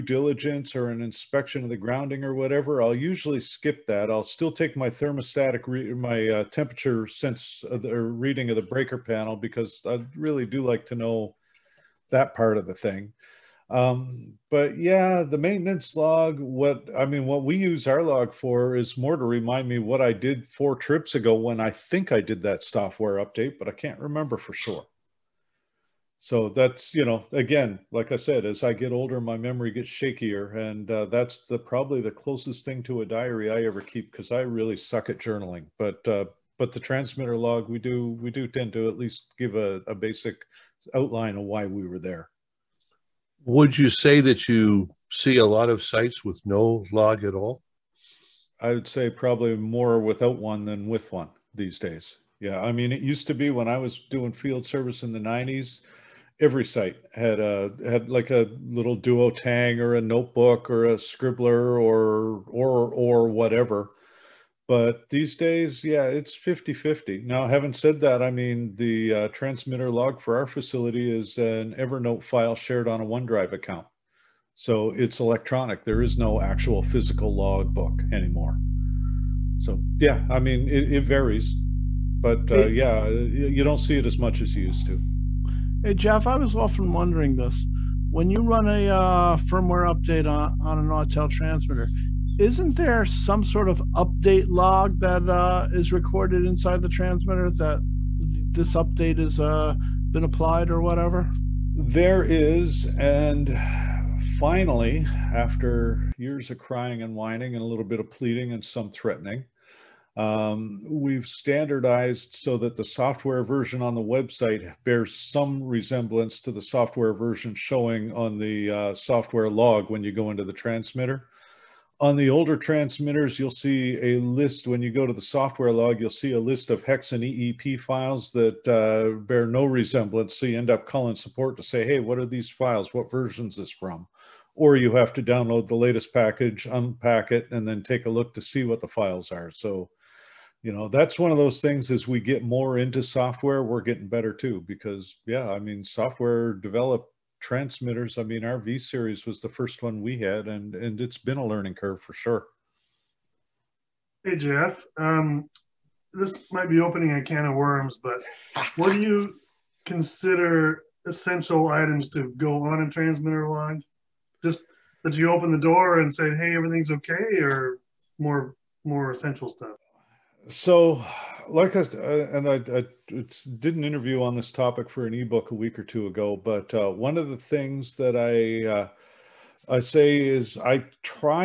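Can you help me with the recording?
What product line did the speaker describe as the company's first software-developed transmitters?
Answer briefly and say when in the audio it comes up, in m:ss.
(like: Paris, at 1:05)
V series, at 2:28.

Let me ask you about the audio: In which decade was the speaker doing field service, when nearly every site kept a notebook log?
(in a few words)
1990s.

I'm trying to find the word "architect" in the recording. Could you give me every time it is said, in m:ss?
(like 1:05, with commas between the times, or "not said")
not said.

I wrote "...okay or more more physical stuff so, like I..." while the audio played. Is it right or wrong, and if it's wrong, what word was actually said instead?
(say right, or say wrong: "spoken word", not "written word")
wrong: "essential", not "physical".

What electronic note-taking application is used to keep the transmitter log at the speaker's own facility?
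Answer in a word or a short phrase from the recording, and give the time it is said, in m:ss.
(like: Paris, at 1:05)
Evernote, at 1:11.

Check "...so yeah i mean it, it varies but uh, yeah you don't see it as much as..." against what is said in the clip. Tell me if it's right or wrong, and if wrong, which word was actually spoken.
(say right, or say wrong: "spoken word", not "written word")
right.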